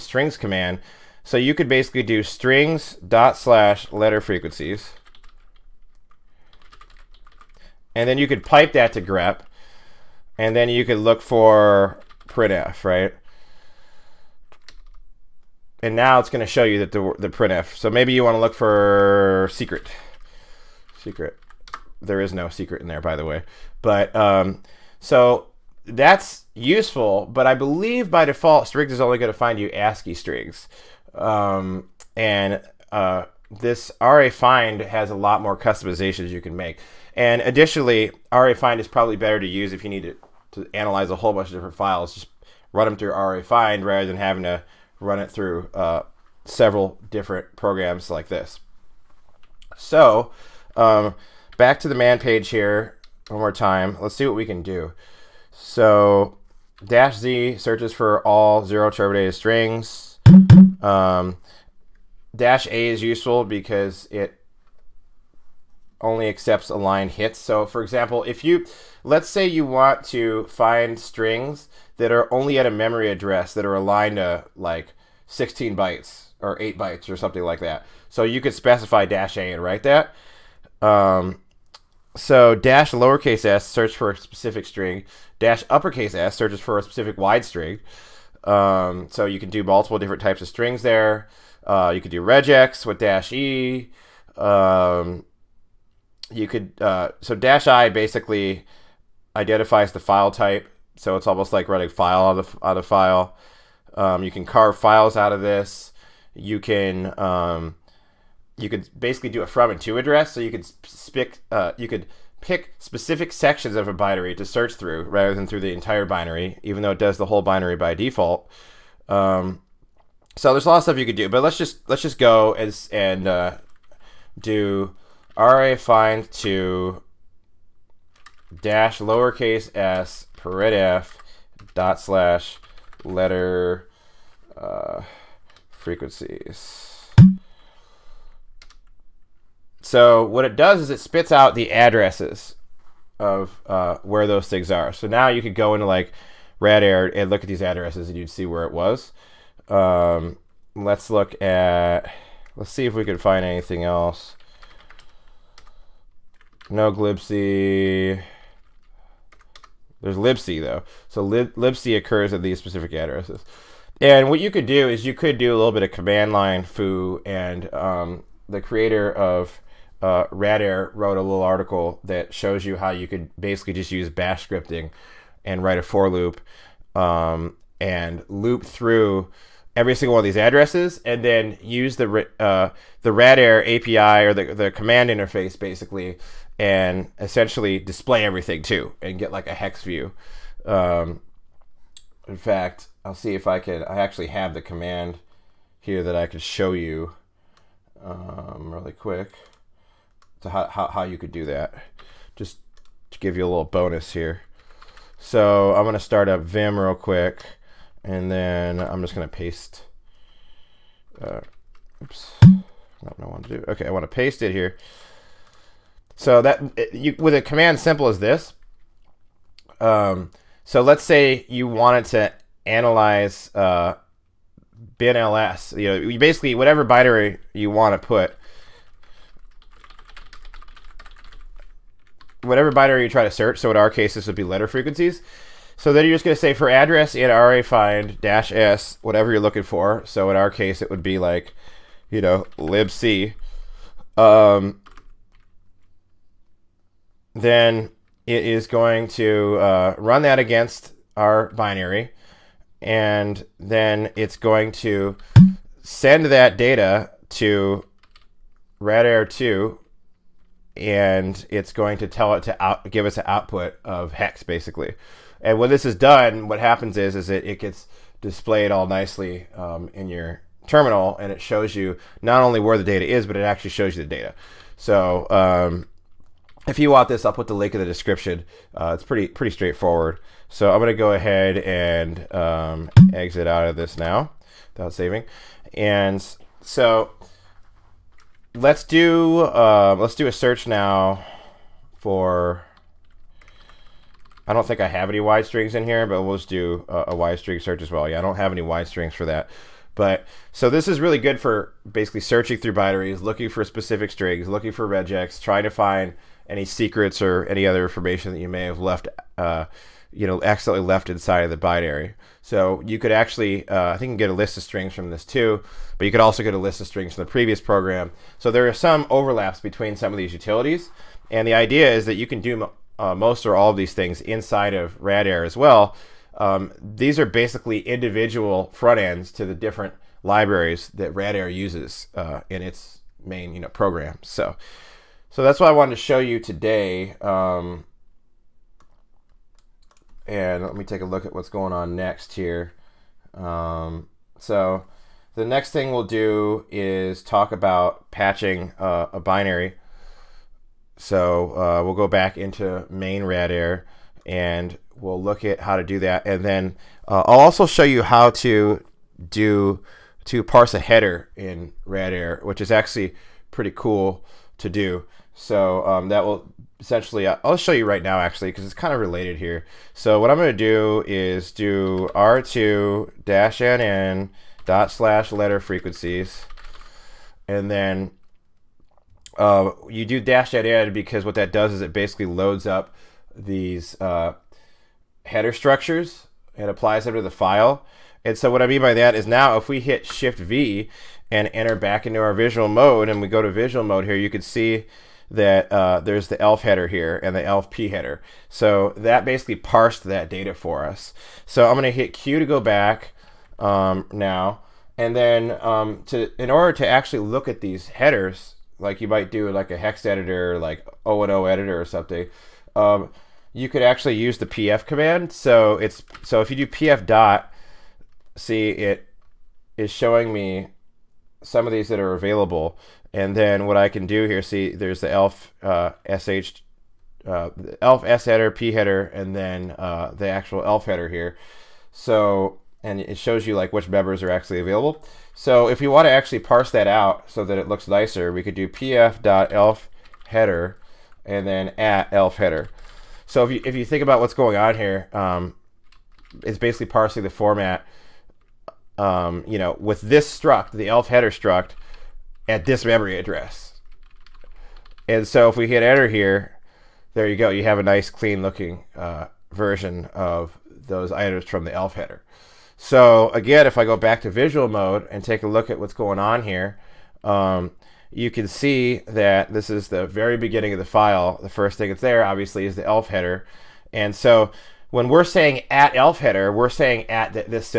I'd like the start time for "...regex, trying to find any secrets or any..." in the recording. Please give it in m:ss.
5:04.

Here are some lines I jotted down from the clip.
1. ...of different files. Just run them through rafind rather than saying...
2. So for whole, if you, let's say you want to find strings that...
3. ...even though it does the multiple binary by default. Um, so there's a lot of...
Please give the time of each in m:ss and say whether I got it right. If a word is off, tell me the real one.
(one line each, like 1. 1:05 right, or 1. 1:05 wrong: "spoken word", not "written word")
1. 0:41 wrong: "having", not "saying"
2. 1:07 wrong: "example", not "whole"
3. 1:56 wrong: "whole", not "multiple".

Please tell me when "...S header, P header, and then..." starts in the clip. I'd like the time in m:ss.
7:08.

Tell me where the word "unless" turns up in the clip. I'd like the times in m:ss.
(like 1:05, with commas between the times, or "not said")
not said.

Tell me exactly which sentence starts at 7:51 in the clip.
The first thing that's there, obviously, is the elf header.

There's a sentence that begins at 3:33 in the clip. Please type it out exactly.
Okay, I wanna paste it here.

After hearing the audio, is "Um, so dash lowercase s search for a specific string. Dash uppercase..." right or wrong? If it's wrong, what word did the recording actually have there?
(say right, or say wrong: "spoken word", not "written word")
right.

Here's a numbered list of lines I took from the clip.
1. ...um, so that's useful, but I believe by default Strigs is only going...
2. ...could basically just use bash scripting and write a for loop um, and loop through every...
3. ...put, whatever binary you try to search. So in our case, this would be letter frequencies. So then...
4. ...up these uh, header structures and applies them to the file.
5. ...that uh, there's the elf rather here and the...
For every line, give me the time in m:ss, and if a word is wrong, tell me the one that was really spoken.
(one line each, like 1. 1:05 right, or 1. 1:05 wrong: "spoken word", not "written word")
1. 0:24 right
2. 2:53 right
3. 3:48 right
4. 6:22 right
5. 6:35 wrong: "header", not "rather".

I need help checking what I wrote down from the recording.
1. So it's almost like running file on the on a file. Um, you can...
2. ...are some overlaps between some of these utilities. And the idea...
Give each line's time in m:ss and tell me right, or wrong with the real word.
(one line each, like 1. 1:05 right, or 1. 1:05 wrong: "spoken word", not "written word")
1. 1:40 right
2. 5:18 right.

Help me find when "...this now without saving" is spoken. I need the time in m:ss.
4:43.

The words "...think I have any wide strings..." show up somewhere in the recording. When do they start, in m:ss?
4:54.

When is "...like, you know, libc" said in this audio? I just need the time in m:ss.
4:01.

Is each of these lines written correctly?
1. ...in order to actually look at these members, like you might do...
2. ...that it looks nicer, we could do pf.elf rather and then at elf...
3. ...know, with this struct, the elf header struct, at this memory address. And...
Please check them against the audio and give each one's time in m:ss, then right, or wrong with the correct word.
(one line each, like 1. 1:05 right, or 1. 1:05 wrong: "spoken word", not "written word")
1. 6:46 wrong: "headers", not "members"
2. 7:17 wrong: "header", not "rather"
3. 7:29 right.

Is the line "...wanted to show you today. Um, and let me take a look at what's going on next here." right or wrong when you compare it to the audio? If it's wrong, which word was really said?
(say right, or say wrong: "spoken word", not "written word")
right.